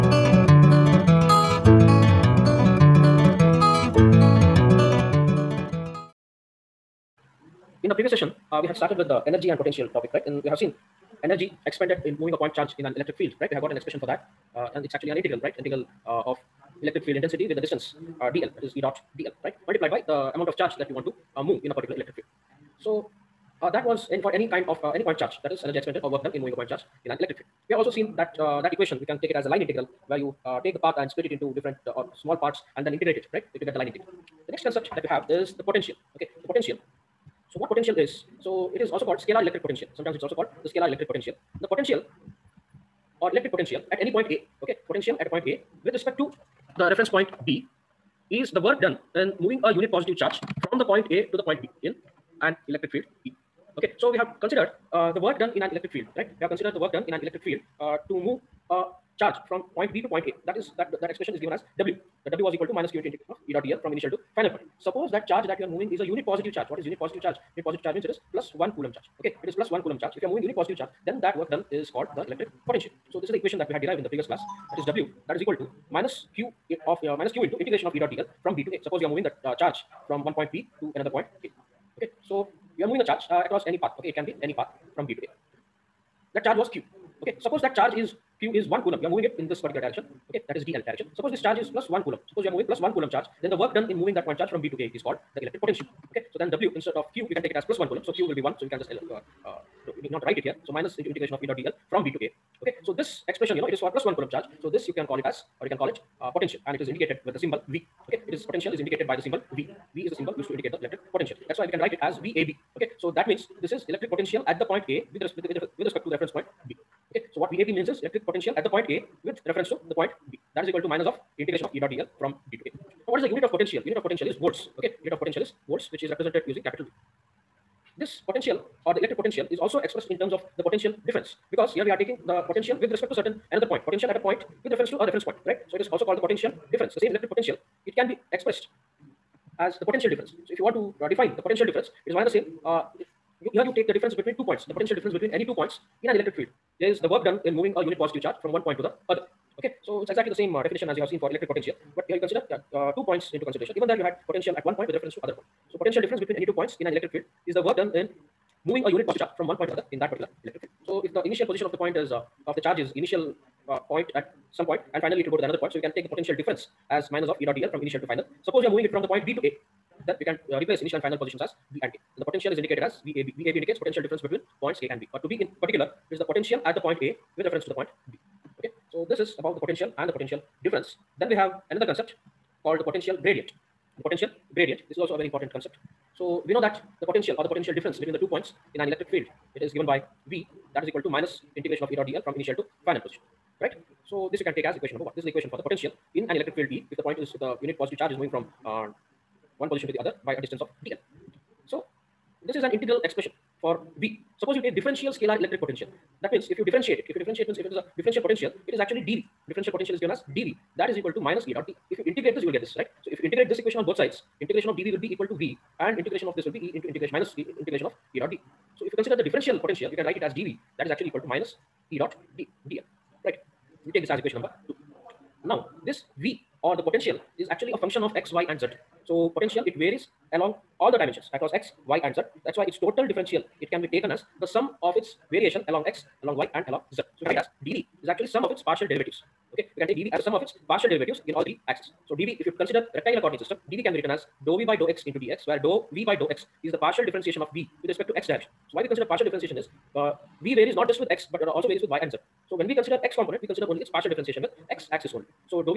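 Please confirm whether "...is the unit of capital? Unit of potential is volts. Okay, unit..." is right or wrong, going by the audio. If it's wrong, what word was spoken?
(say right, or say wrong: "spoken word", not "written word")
wrong: "potential", not "capital".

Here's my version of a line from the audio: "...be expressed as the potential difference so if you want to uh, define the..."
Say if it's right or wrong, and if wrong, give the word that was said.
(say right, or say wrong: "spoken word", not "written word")
right.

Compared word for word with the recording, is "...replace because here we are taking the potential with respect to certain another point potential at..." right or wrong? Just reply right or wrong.
wrong.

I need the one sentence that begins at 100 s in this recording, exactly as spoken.
So minus into integration of E dot dl from B to A.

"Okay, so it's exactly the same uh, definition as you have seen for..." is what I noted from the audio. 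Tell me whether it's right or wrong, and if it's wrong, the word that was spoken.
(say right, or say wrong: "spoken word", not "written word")
right.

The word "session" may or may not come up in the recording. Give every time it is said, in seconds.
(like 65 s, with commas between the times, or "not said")
8 s.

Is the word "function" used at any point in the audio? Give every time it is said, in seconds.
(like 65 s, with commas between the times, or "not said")
227 s.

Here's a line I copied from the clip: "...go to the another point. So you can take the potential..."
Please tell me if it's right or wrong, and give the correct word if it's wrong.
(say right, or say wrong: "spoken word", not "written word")
right.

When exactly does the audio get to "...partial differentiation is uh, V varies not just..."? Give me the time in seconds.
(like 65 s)
249 s.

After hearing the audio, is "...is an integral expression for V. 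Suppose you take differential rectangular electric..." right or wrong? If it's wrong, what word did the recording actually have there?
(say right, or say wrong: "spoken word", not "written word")
wrong: "scalar", not "rectangular".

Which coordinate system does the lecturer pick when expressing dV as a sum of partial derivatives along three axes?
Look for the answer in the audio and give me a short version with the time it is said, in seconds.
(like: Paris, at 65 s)
rectangular coordinate system, at 242 s.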